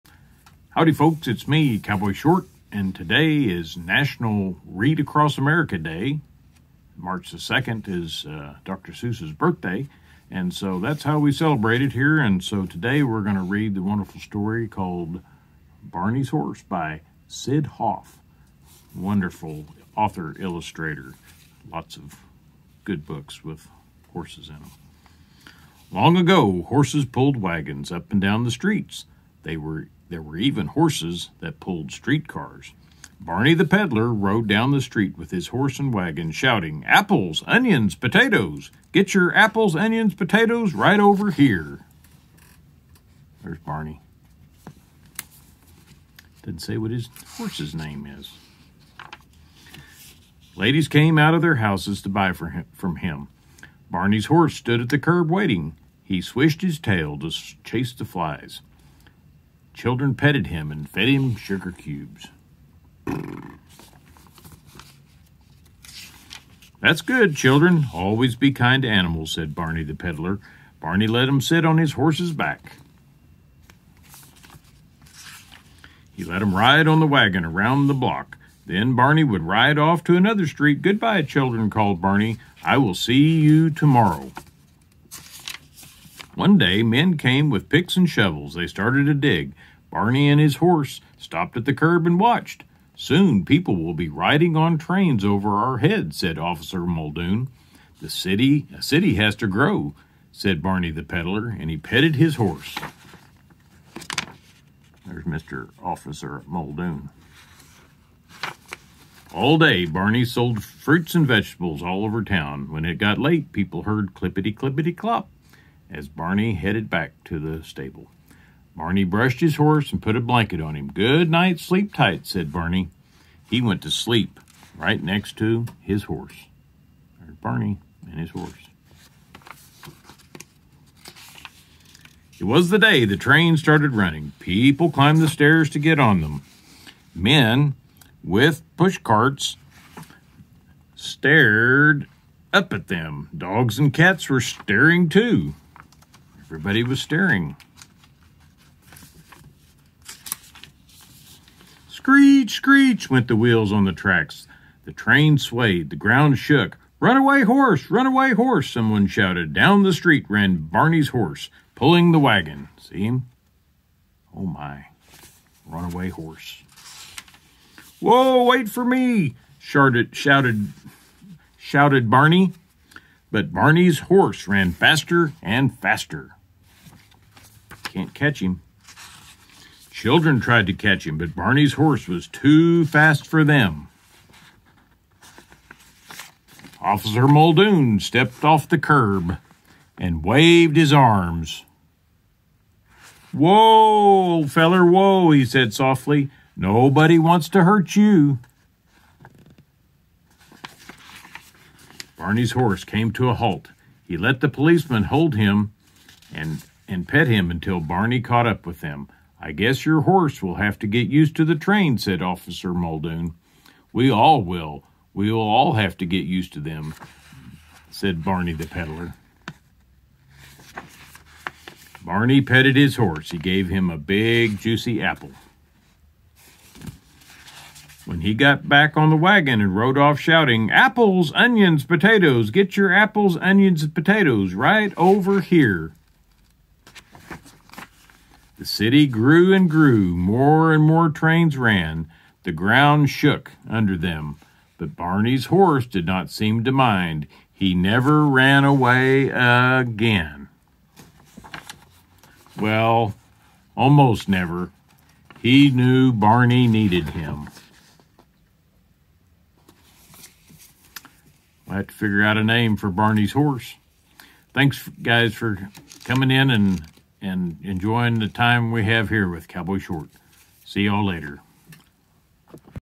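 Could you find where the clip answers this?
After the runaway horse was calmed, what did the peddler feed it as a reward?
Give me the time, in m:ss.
3:43.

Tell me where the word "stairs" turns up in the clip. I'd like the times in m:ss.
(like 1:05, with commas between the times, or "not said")
2:15.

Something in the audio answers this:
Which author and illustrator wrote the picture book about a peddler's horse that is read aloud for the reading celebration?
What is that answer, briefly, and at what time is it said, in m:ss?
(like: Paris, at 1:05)
Syd Hoff, at 0:17.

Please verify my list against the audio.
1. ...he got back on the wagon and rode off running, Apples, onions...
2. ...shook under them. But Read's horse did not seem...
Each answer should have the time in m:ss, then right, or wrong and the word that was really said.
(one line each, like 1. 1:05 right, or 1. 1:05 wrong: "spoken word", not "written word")
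1. 3:48 wrong: "shouting", not "running"
2. 4:03 wrong: "Barney", not "Read".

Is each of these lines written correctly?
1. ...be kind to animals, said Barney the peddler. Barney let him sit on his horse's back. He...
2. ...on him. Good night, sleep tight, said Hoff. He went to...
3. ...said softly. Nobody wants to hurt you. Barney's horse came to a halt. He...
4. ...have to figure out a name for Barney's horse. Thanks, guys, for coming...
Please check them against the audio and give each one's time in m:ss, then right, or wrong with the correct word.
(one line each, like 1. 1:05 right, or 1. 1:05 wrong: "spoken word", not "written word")
1. 1:08 right
2. 2:00 wrong: "Barney", not "Hoff"
3. 3:15 right
4. 4:21 right.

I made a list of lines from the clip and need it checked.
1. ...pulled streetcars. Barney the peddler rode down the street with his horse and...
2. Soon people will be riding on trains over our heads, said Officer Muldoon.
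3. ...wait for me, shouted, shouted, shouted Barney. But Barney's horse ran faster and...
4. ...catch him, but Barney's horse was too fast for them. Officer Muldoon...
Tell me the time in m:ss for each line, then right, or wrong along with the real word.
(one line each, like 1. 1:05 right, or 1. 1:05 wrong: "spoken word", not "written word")
1. 0:31 right
2. 1:32 right
3. 2:48 right
4. 3:00 right.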